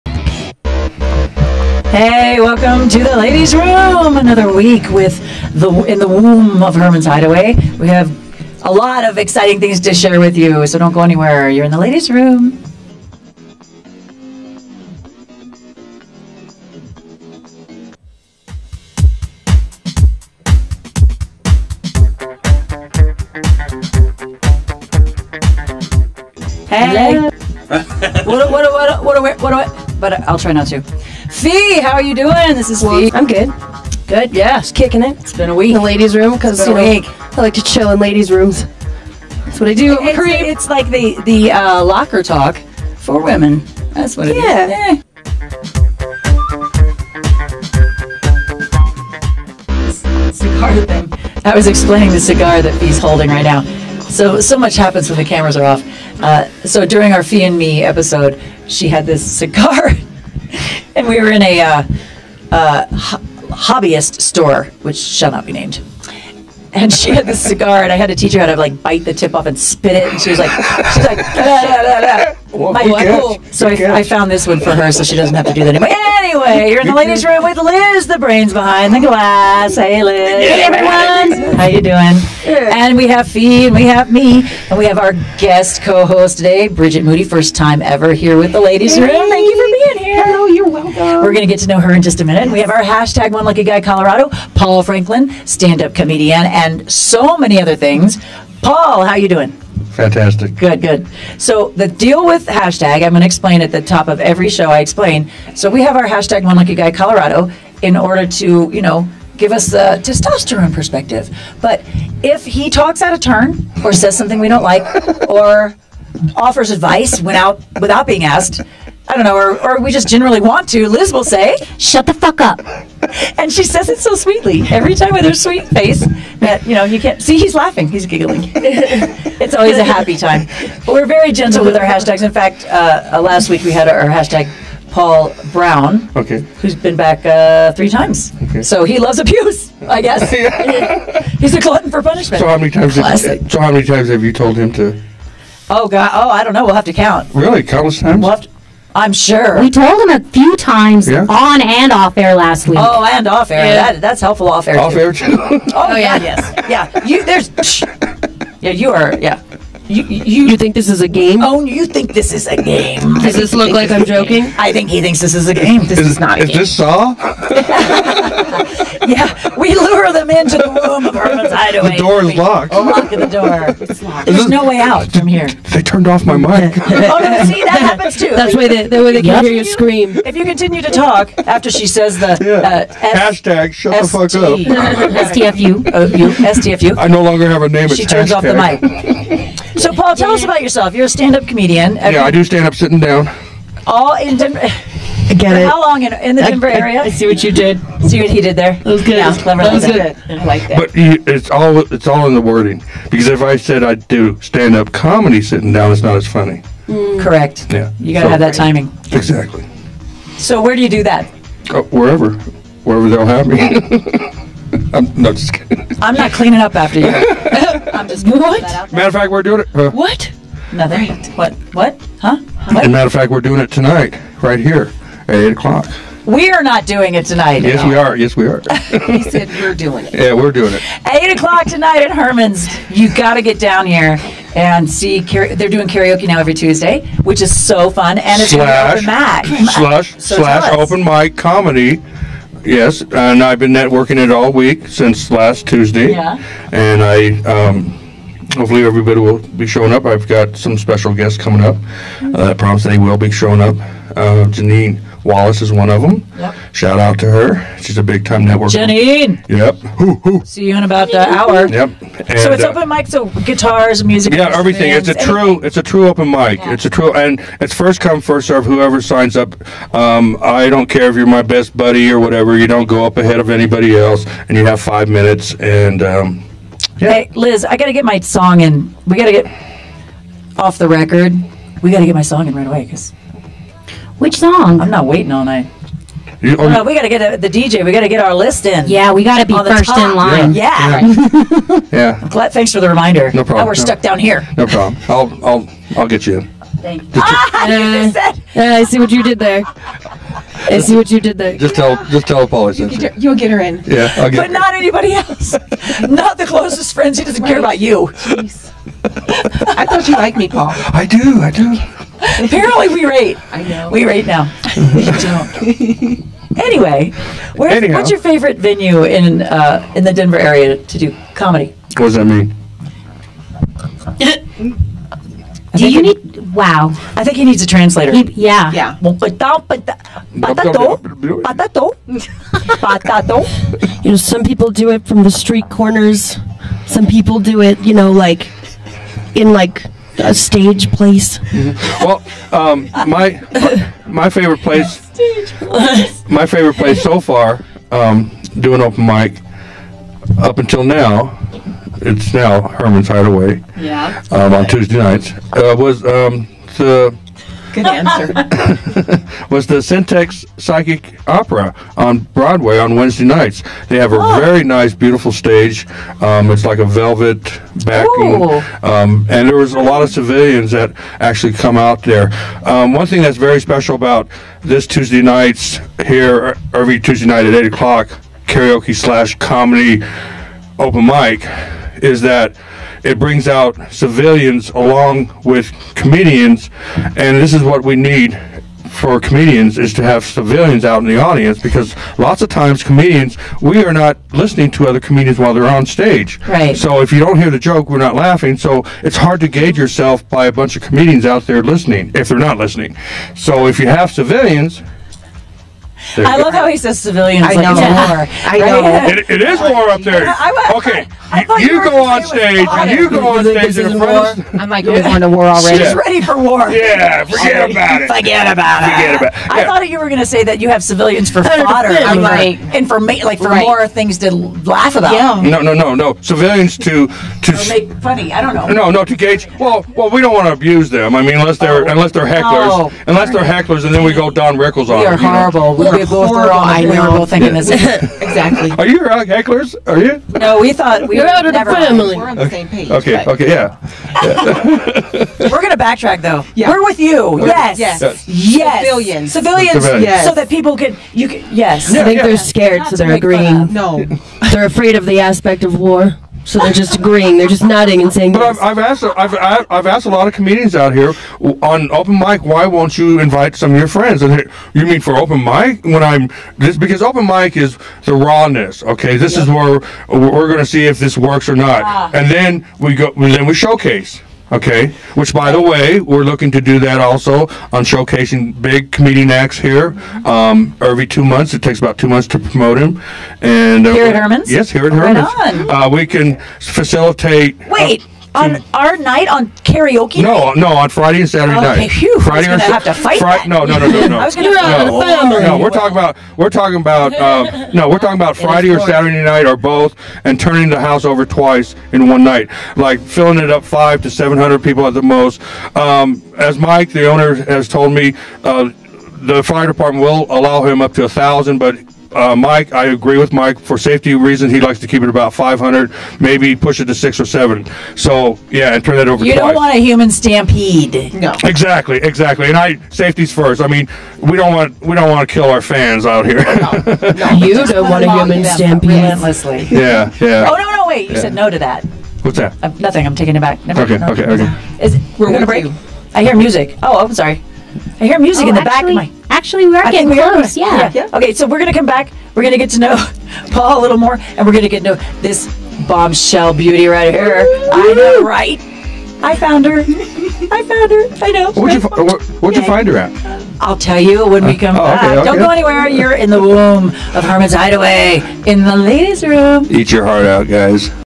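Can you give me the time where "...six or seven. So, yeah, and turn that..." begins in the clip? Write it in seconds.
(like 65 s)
516 s.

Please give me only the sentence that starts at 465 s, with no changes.
When I'm this because open mic is the rawness.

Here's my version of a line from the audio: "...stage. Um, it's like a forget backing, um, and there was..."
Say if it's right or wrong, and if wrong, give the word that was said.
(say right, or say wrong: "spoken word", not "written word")
wrong: "velvet", not "forget".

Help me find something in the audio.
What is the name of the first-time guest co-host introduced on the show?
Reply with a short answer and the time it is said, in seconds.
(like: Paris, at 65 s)
Bridget Moody, at 86 s.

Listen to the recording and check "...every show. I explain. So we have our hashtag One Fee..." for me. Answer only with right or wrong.
wrong.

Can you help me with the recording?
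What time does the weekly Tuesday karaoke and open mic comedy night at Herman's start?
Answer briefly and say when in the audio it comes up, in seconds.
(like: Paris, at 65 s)
8 o'clock, at 225 s.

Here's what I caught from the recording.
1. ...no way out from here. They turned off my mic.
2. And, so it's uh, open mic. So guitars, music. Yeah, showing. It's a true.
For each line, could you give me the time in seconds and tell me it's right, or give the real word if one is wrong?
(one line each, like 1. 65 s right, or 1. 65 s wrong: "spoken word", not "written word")
1. 174 s right
2. 262 s wrong: "everything", not "showing".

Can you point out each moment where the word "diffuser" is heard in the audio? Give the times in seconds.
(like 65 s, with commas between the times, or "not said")
not said.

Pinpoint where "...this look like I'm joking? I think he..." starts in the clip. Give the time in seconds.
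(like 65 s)
163 s.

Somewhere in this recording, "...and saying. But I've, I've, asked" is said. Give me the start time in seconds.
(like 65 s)
458 s.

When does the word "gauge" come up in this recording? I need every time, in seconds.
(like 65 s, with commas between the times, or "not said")
399 s, 429 s.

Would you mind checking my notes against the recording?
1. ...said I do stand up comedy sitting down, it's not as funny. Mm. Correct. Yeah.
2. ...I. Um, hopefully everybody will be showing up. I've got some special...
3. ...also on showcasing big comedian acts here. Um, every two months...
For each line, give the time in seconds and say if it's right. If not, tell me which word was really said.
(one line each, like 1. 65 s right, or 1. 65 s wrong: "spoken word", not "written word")
1. 203 s right
2. 247 s right
3. 476 s right.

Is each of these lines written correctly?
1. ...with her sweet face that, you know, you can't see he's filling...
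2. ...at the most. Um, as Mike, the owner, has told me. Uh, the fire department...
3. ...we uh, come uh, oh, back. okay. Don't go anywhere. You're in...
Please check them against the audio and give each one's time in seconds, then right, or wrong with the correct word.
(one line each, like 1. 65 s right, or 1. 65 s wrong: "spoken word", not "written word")
1. 125 s wrong: "laughing", not "filling"
2. 504 s right
3. 554 s right.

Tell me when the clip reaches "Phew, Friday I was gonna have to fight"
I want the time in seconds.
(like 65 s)
491 s.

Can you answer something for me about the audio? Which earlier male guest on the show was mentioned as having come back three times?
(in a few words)
Paul Brown.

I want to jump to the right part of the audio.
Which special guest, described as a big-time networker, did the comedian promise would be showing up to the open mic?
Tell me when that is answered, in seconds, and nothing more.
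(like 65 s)
254 s.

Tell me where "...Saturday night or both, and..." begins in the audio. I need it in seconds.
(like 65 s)
498 s.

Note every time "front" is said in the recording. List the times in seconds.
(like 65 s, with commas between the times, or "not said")
413 s.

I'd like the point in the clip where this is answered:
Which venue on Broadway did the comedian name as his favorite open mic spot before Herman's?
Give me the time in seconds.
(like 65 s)
359 s.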